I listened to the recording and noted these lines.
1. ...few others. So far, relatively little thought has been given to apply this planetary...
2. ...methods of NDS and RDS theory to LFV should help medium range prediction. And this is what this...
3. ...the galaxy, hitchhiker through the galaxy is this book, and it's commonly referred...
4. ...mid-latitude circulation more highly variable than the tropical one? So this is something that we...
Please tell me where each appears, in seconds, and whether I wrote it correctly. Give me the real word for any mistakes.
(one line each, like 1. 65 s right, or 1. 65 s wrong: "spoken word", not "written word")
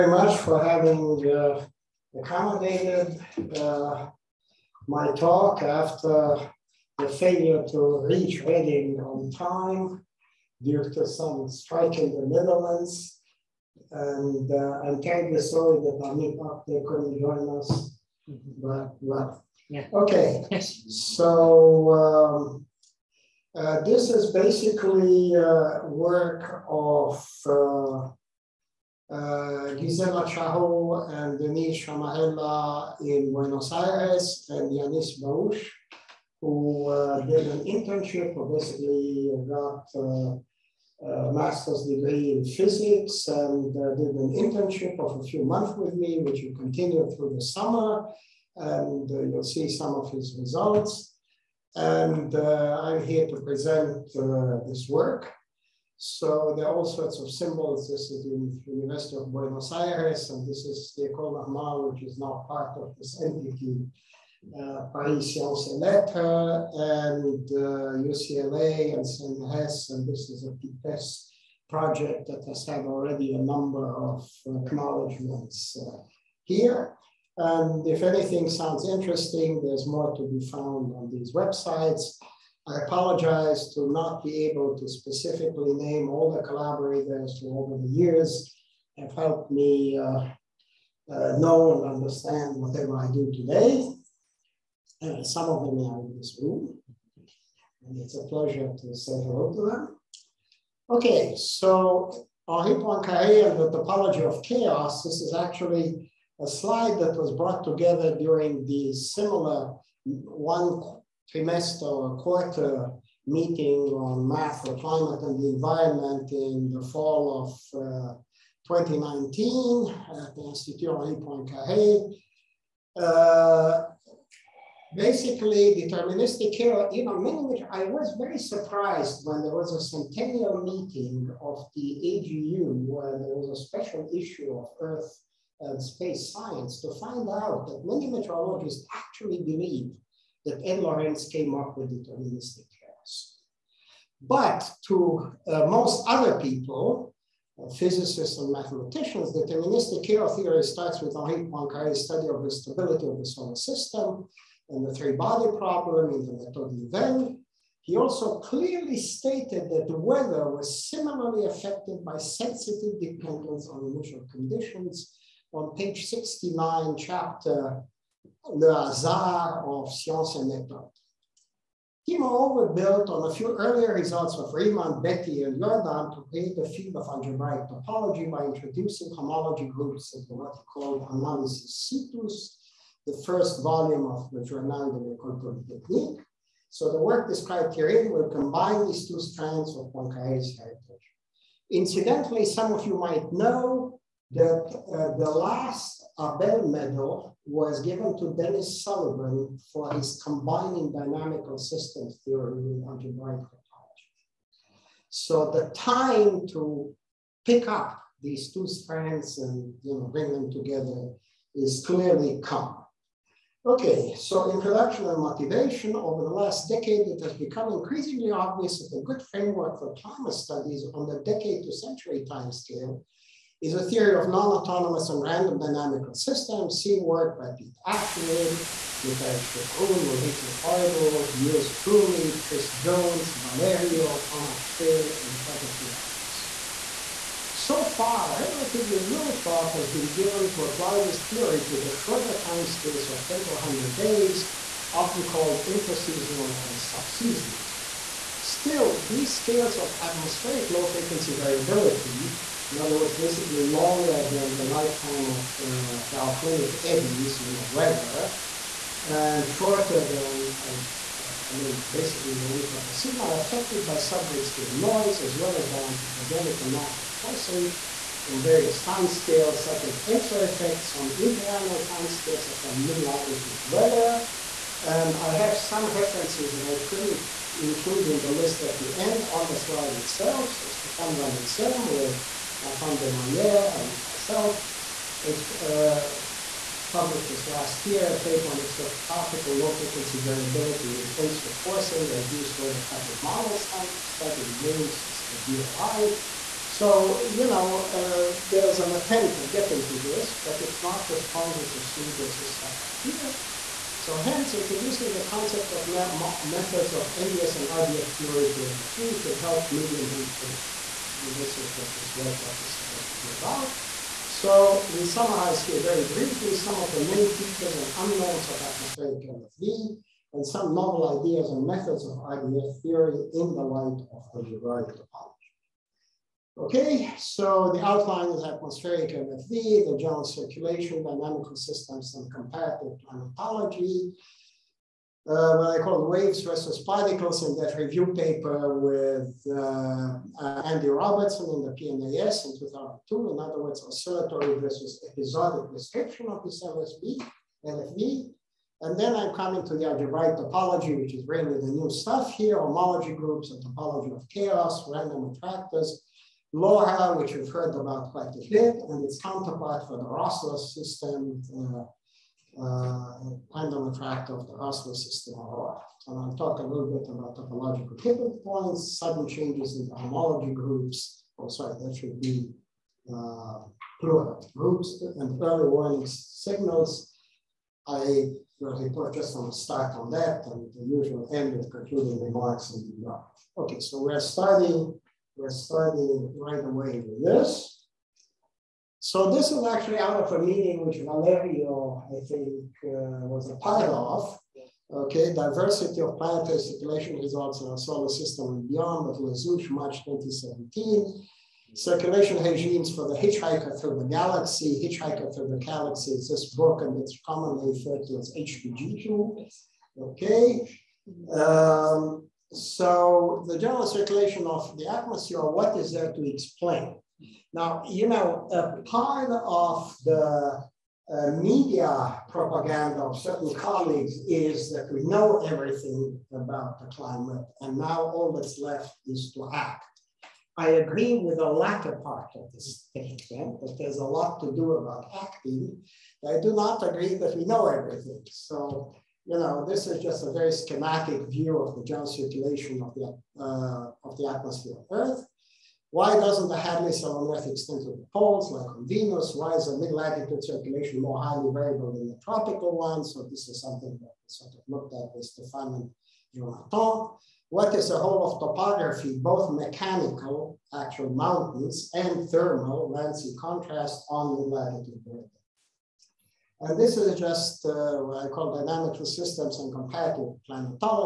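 1. 235 s wrong: "theory", not "planetary"
2. 305 s right
3. 403 s right
4. 449 s right.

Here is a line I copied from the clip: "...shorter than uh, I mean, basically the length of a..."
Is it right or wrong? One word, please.
right.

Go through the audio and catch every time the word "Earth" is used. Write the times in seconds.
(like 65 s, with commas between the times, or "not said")
134 s, 444 s.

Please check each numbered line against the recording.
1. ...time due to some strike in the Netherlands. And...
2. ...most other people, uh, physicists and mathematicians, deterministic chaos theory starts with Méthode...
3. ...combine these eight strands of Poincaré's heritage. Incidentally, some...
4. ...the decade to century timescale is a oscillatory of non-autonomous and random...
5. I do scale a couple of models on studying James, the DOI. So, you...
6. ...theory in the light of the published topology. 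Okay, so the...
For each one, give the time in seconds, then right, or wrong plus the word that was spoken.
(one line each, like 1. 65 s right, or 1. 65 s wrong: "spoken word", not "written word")
1. 9 s right
2. 145 s wrong: "Henri", not "Méthode"
3. 188 s wrong: "two", not "eight"
4. 221 s wrong: "theory", not "oscillatory"
5. 292 s wrong: "stole", not "scale"
6. 322 s wrong: "derived", not "published".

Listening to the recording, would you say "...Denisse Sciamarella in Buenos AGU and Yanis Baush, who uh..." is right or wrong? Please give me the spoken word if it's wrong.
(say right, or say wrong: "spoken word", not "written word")
wrong: "Aires", not "AGU".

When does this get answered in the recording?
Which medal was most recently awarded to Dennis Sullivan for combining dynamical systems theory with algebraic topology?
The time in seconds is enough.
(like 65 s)
196 s.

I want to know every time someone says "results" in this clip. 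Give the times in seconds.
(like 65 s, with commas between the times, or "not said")
50 s, 173 s, 397 s.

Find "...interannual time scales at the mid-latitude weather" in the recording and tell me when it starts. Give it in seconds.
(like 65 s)
271 s.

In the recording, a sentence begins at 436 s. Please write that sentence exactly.
I do not agree that we know everything.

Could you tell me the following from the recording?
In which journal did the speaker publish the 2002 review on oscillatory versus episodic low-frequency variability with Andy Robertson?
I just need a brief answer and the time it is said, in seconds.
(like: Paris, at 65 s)
PNAS, at 341 s.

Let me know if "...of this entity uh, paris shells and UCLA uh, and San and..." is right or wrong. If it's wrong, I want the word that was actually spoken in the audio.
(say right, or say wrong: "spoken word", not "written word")
right.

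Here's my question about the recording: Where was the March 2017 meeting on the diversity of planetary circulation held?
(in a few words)
Les Houches.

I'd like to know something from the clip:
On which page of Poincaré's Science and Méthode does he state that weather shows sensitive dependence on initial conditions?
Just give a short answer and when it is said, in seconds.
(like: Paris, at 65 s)
69, at 166 s.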